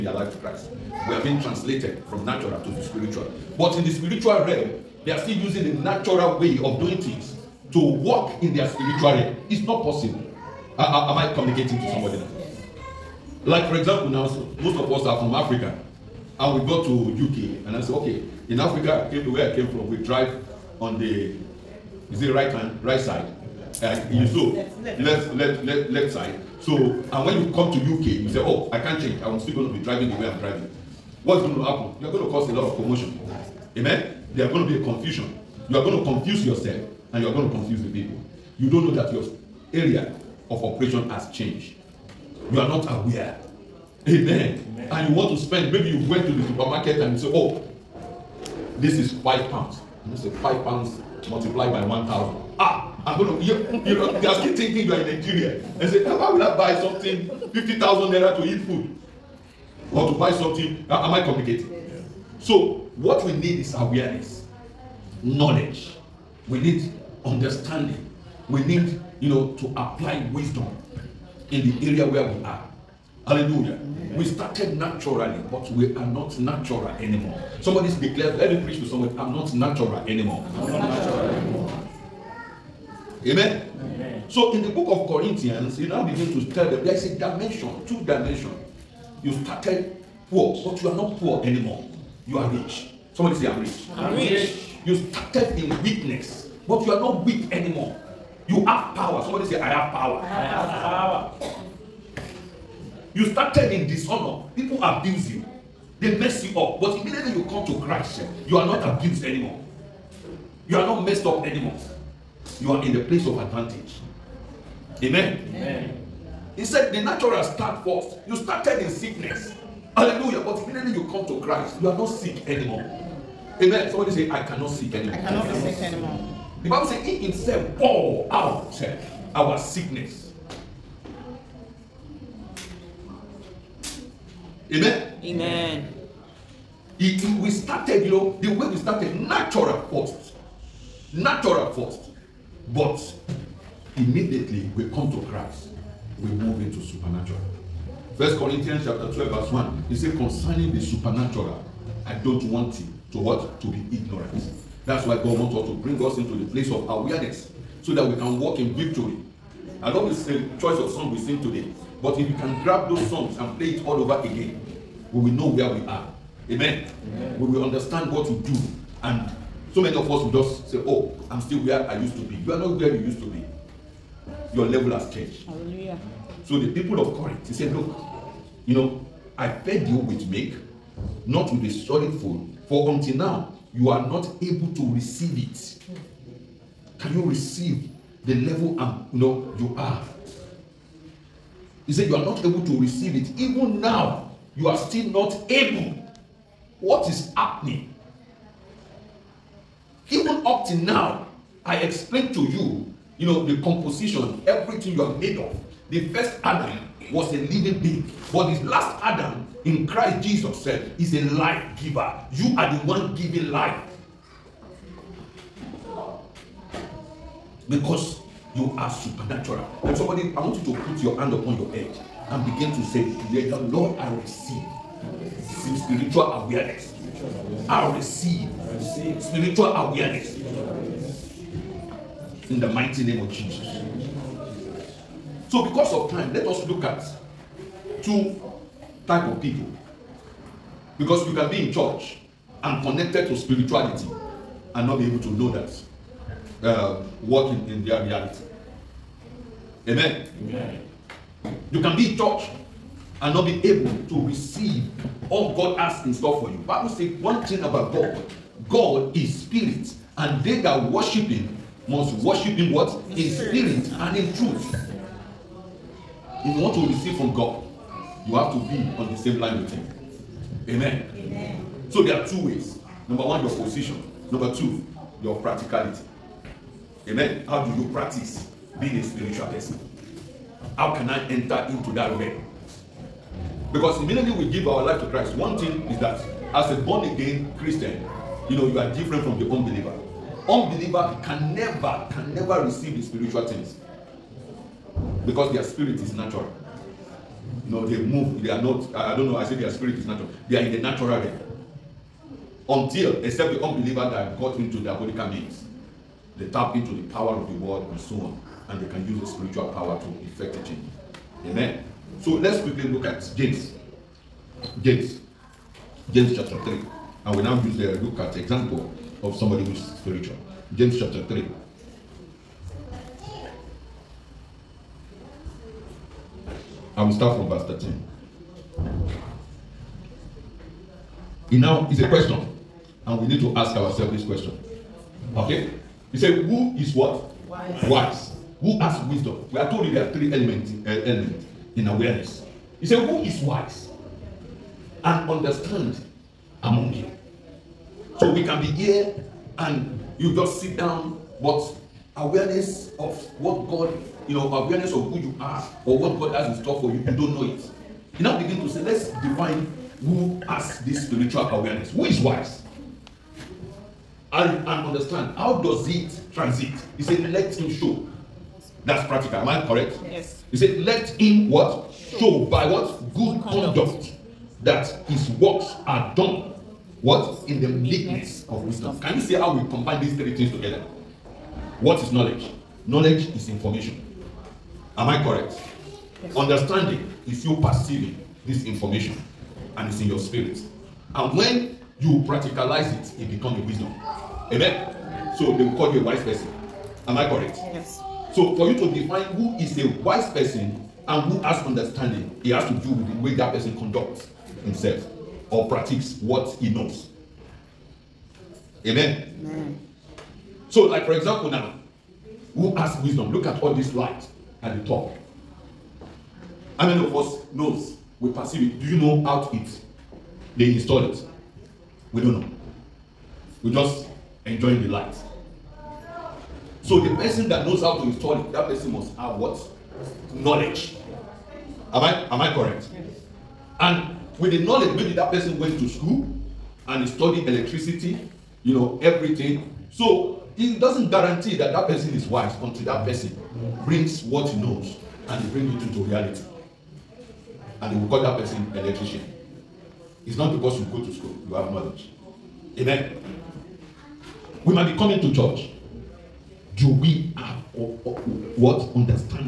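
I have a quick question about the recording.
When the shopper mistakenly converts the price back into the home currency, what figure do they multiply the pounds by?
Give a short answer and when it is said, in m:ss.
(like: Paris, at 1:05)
1,000, at 0:51.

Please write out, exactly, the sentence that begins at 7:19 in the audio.
So it doesn't guarantee that that person is wise until that person brings what he knows and he brings it into reality.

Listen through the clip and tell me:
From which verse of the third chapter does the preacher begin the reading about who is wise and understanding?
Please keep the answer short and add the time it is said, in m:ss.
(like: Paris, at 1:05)
Verse 13, at 5:27.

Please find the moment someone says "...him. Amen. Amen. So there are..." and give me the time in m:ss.
4:29.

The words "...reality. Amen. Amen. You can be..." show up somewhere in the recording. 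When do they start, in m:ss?
4:08.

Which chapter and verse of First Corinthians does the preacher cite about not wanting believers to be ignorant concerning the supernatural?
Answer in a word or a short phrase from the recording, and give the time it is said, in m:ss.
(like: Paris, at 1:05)
Chapter 12, verse 1, at 2:28.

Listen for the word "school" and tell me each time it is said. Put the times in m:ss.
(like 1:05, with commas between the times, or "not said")
7:15, 7:31.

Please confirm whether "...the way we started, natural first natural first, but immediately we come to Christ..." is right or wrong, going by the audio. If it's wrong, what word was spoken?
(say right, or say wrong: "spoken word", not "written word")
right.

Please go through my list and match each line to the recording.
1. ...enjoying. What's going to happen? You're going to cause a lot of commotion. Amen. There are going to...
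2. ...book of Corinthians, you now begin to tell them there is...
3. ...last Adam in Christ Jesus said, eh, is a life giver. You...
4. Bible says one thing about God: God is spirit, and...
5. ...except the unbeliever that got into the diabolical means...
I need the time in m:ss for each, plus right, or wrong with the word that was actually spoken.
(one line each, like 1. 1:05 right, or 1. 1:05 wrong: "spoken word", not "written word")
1. 0:30 wrong: "driving", not "enjoying"
2. 1:24 right
3. 3:28 right
4. 4:16 right
5. 5:03 right.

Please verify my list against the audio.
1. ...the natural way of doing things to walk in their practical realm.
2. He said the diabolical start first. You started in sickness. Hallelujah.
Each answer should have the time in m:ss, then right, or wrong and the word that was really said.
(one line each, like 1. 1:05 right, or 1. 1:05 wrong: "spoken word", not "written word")
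1. 0:05 wrong: "spiritual", not "practical"
2. 1:56 wrong: "natural", not "diabolical".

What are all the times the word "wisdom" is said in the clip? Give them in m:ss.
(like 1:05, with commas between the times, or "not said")
1:10, 5:39, 6:18, 6:33, 6:53.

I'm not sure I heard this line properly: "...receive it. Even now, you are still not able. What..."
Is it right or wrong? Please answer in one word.
right.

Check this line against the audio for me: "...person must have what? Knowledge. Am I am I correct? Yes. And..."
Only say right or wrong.
right.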